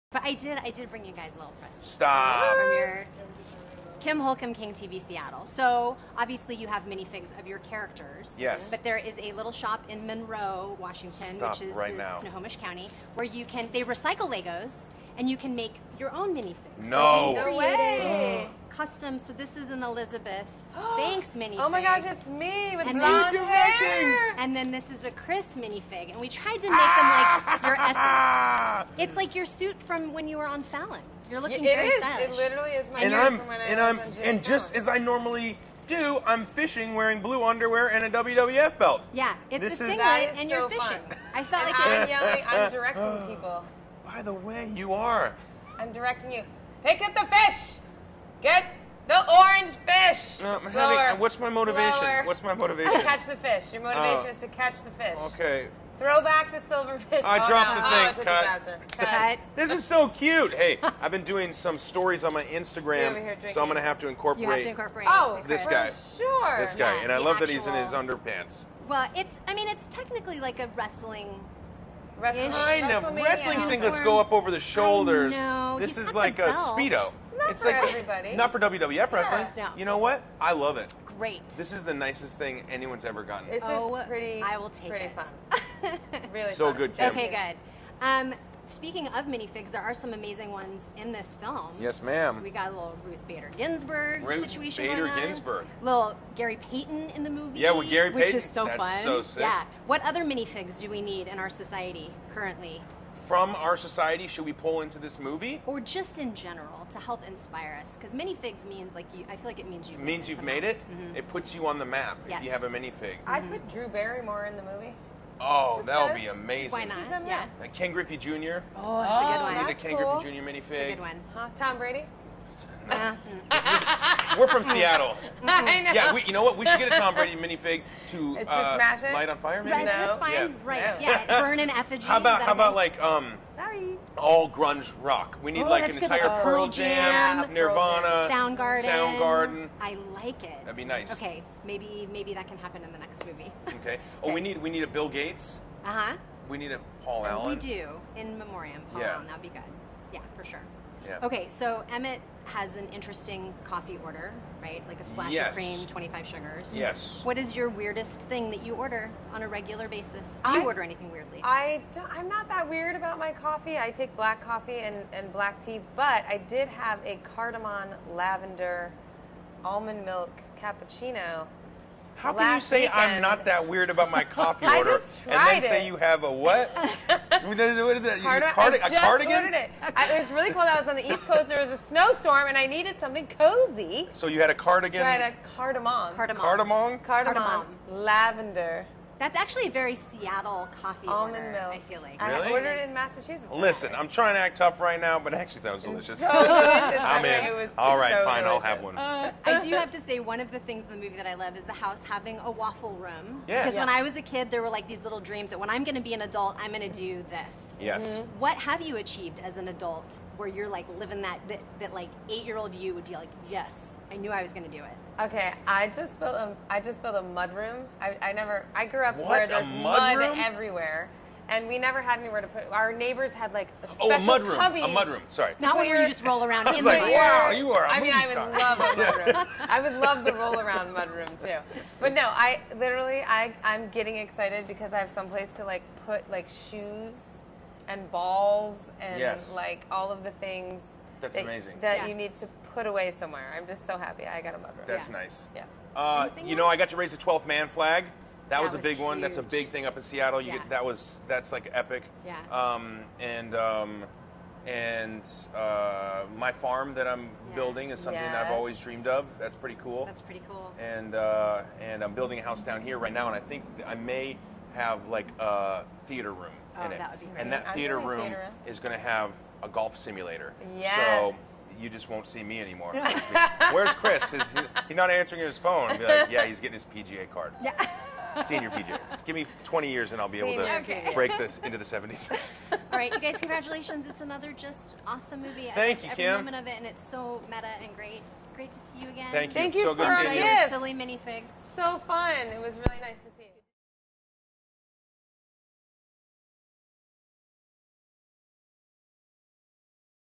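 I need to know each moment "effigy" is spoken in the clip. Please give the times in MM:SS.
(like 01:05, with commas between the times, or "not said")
02:11.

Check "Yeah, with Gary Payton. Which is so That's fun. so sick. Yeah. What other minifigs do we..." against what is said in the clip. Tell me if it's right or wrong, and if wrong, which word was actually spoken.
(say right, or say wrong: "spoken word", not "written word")
right.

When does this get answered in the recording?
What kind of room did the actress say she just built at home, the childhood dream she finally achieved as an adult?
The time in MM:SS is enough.
03:37.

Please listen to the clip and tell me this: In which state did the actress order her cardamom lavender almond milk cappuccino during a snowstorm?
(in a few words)
Massachusetts.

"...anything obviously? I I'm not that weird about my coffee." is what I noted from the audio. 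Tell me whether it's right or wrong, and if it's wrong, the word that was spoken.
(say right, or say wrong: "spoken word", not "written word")
wrong: "weirdly", not "obviously".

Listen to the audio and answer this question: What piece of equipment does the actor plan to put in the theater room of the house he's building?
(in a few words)
Golf simulator.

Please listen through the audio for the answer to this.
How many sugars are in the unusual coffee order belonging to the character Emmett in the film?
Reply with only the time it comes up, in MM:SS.
02:35.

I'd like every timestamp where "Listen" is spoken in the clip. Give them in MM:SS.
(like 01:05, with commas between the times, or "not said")
03:13.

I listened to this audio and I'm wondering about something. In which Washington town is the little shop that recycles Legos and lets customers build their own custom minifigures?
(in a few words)
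Monroe.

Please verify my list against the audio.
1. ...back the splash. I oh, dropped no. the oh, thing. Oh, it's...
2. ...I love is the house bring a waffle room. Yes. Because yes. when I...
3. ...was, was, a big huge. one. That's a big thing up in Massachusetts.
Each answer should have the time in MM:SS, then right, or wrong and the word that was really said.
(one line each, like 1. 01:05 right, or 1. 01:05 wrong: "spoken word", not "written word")
1. 00:56 wrong: "silverfish", not "splash"
2. 03:21 wrong: "having", not "bring"
3. 04:08 wrong: "Seattle", not "Massachusetts".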